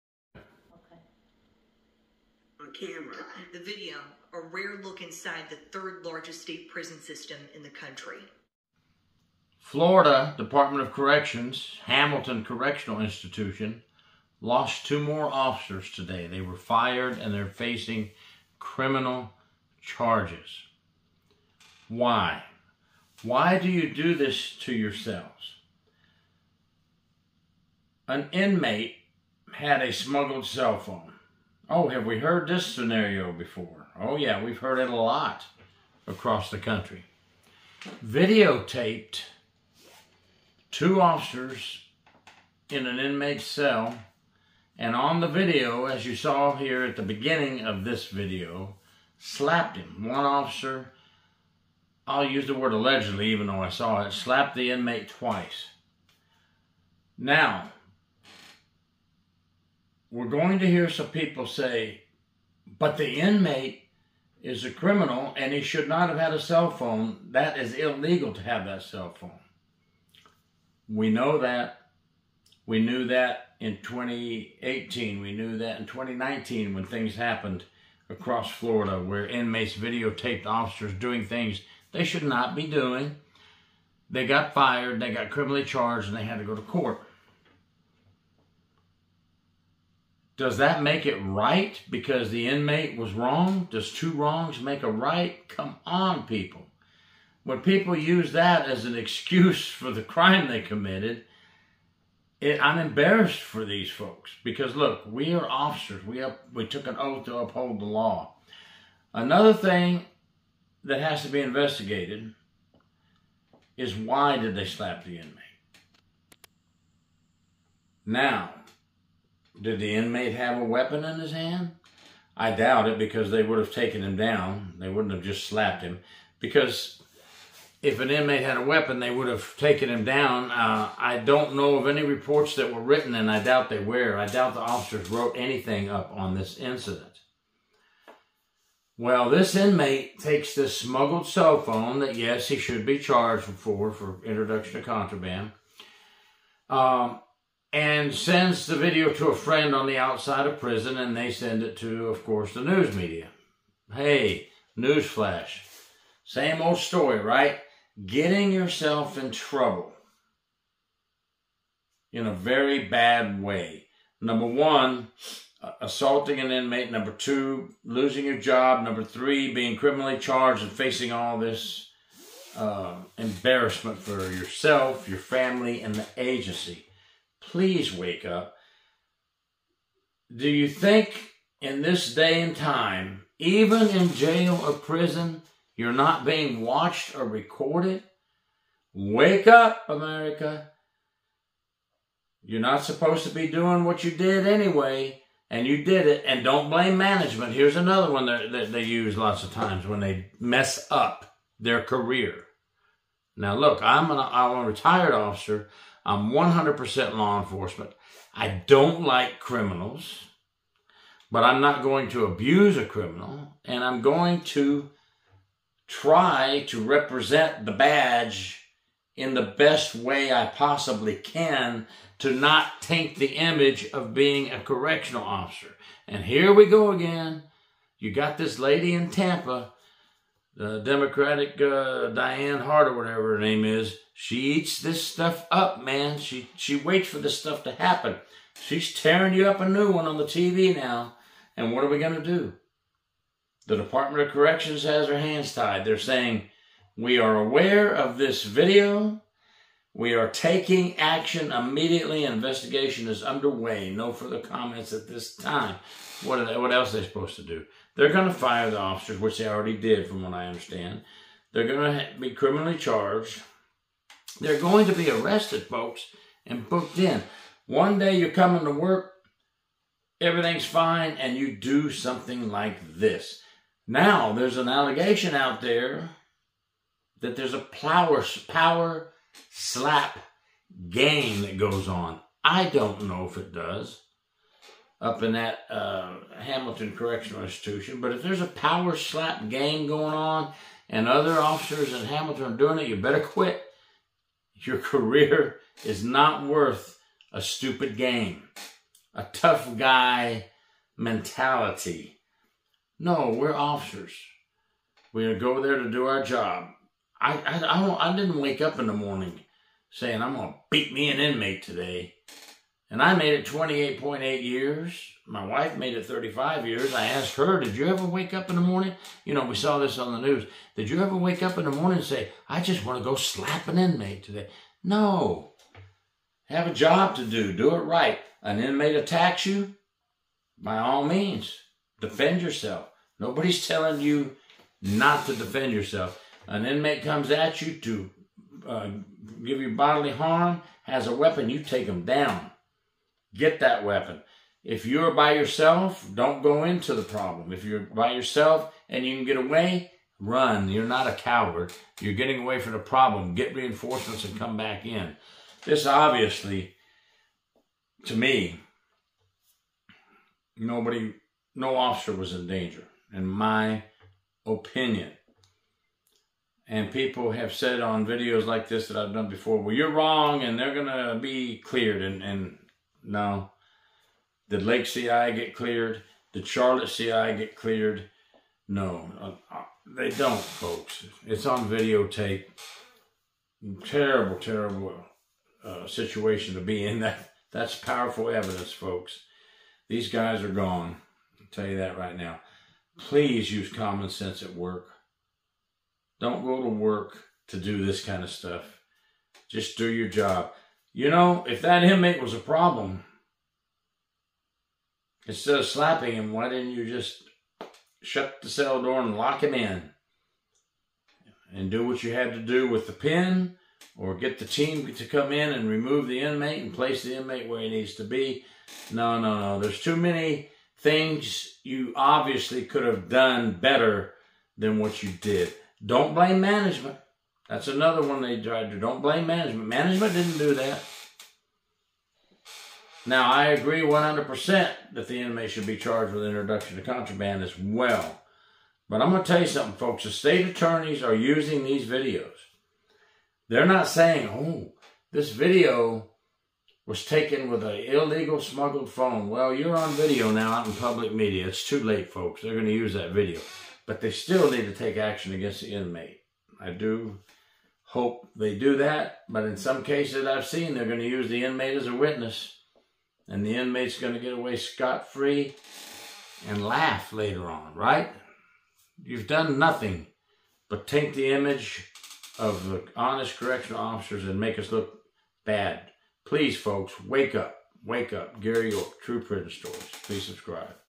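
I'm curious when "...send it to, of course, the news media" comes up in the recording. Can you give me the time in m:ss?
2:31.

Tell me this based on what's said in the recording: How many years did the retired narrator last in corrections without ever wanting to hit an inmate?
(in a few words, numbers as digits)
28.8.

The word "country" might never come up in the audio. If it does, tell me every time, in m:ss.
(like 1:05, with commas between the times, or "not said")
0:07, 0:36.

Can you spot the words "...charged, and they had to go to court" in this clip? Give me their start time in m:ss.
1:25.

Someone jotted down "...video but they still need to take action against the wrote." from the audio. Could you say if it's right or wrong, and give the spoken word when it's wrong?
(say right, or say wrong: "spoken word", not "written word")
wrong: "inmate", not "wrote".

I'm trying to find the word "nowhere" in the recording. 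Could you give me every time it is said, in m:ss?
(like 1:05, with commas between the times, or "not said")
not said.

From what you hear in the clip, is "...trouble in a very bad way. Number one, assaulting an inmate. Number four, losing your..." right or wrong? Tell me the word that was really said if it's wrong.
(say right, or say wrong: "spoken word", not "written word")
wrong: "two", not "four".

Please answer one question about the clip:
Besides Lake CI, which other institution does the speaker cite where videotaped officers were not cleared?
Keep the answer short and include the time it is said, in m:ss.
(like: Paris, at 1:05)
Charlotte CI, at 6:16.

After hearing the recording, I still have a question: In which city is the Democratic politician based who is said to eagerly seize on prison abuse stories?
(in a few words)
Tampa.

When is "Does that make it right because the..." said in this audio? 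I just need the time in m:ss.
1:30.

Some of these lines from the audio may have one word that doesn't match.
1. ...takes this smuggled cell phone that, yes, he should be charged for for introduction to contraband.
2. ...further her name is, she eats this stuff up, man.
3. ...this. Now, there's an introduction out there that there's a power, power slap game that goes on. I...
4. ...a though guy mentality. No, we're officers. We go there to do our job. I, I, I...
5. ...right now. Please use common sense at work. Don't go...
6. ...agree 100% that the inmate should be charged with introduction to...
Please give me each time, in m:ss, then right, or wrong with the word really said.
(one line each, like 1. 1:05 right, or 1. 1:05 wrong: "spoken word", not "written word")
1. 2:20 right
2. 3:52 wrong: "whatever", not "further"
3. 4:32 wrong: "allegation", not "introduction"
4. 4:59 wrong: "tough", not "though"
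5. 6:31 right
6. 7:13 right.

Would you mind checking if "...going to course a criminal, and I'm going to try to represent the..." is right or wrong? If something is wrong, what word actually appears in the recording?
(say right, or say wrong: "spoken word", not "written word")
wrong: "abuse", not "course".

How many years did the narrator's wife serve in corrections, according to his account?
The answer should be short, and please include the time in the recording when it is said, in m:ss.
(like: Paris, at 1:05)
35, at 5:16.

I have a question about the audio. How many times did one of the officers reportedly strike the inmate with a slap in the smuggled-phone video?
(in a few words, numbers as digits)
2.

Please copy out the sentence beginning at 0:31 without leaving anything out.
Oh, have we heard this scenario before?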